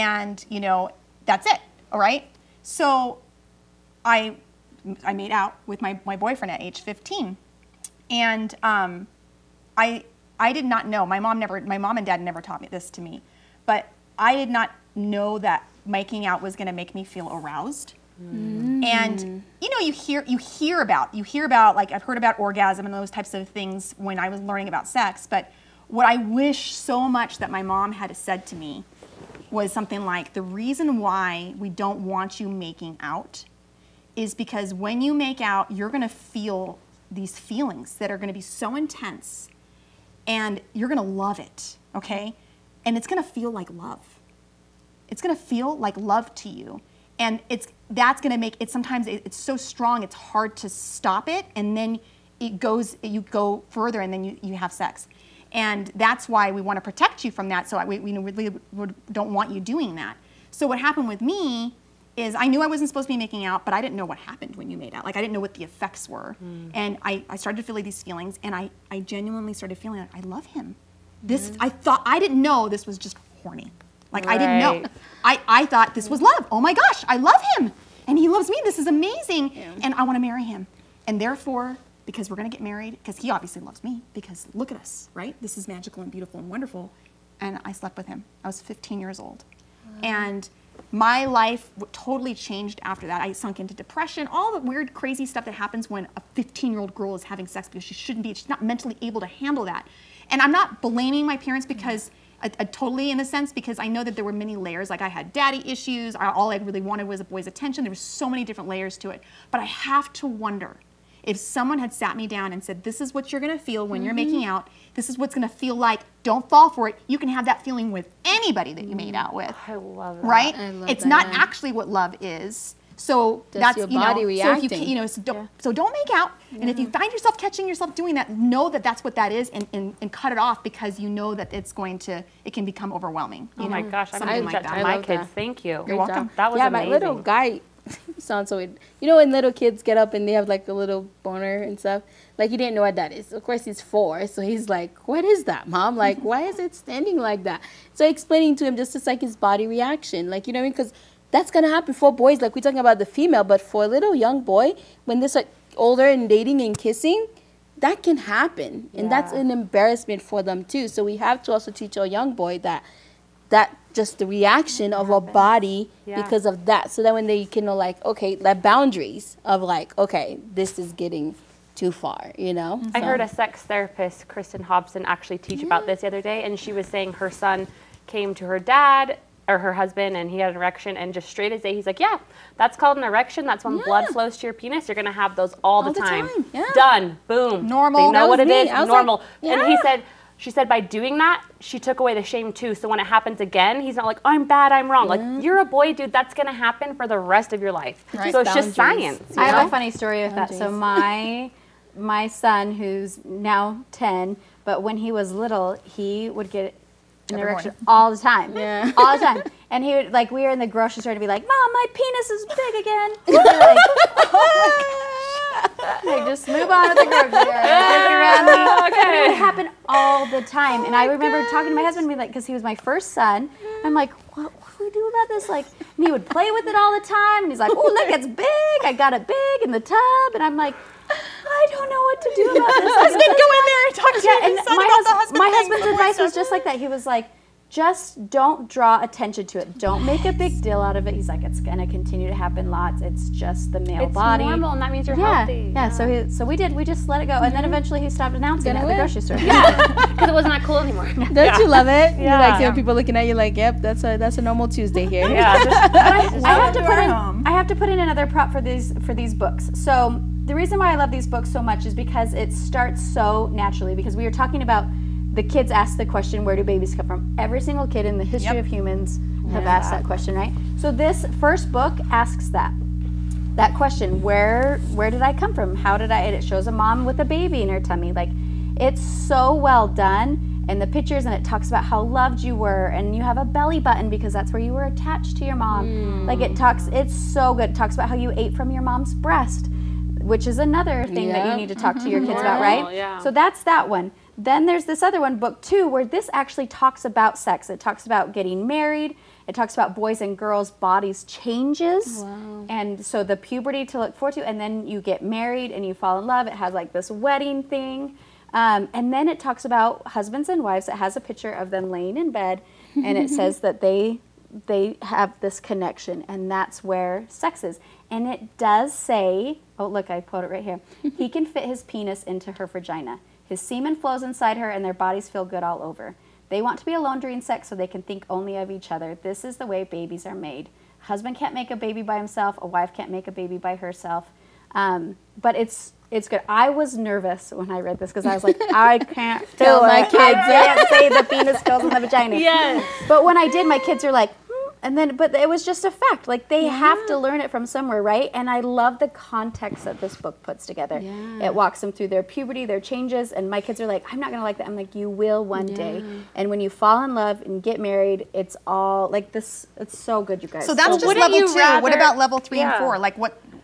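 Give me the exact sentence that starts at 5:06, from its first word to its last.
It has like this wedding thing, um, and then it talks about husbands and wives.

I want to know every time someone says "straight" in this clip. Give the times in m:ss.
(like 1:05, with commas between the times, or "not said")
3:01.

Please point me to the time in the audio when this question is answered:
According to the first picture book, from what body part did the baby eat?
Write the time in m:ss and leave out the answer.
4:48.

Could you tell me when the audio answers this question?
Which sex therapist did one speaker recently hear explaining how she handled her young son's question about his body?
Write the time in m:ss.
2:54.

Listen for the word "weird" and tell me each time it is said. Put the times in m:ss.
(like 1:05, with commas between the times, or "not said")
1:34, 2:18.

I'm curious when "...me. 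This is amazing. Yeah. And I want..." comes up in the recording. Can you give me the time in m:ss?
1:18.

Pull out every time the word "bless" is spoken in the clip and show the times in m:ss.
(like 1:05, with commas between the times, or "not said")
not said.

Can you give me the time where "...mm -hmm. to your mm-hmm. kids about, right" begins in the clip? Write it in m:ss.
4:51.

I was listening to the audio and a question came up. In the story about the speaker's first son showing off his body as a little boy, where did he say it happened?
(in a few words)
in the tub.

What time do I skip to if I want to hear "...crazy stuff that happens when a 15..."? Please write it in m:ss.
1:34.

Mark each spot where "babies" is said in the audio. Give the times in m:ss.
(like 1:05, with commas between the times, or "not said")
4:26, 5:29.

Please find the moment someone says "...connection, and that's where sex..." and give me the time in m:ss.
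5:15.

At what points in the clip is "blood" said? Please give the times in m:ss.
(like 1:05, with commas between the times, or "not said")
3:03.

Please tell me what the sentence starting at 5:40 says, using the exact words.
I can't say the penis goes in the vagina.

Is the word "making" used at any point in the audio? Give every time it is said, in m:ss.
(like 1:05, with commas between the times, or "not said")
0:15, 0:32, 1:03, 1:54.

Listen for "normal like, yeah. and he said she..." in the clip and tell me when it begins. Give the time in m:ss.
3:08.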